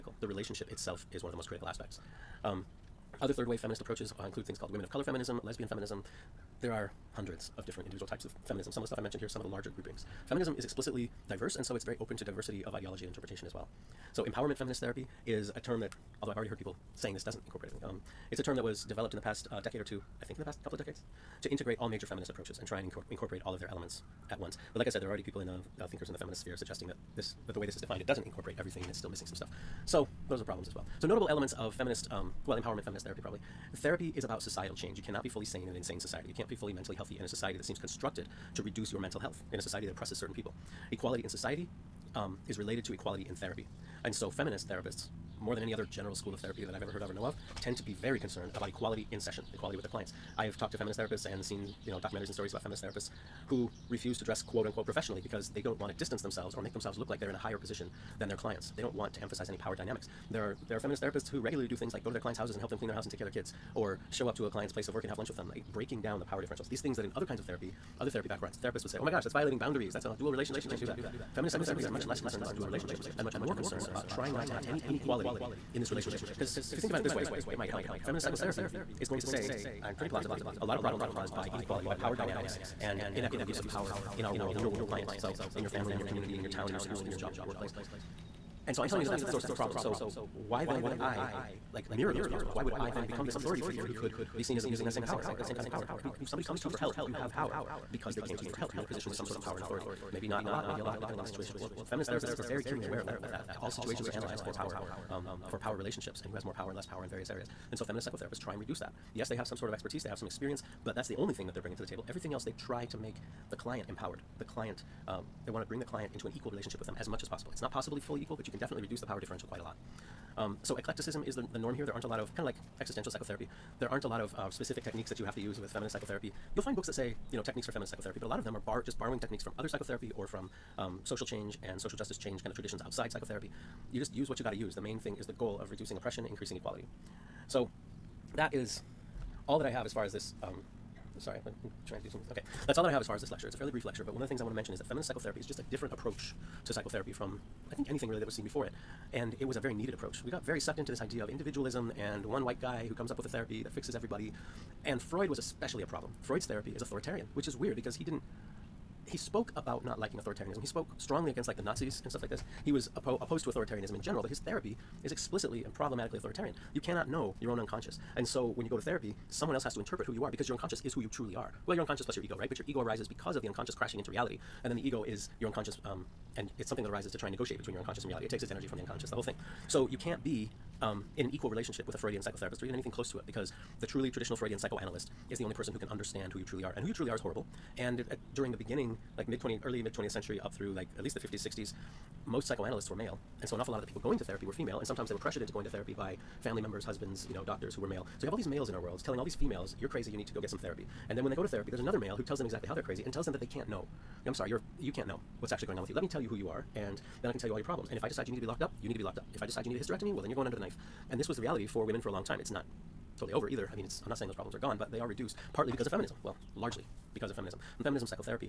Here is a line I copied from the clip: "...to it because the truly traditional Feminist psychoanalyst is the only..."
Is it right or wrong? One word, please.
wrong.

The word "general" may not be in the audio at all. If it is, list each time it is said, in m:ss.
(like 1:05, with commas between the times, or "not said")
0:45, 2:44.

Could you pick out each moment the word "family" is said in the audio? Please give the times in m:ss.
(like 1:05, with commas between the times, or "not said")
1:25, 3:16.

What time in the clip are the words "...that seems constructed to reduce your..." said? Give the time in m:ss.
0:37.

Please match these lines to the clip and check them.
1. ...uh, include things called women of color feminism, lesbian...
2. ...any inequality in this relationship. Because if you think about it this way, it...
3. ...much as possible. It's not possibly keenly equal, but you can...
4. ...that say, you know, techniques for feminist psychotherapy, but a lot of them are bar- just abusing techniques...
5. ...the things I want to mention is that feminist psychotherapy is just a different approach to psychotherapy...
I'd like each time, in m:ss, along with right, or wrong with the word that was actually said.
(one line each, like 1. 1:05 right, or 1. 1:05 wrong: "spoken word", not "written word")
1. 0:04 right
2. 1:14 right
3. 1:57 wrong: "fully", not "keenly"
4. 2:06 wrong: "borrowing", not "abusing"
5. 2:24 right.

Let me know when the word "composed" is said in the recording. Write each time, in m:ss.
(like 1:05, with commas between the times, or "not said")
not said.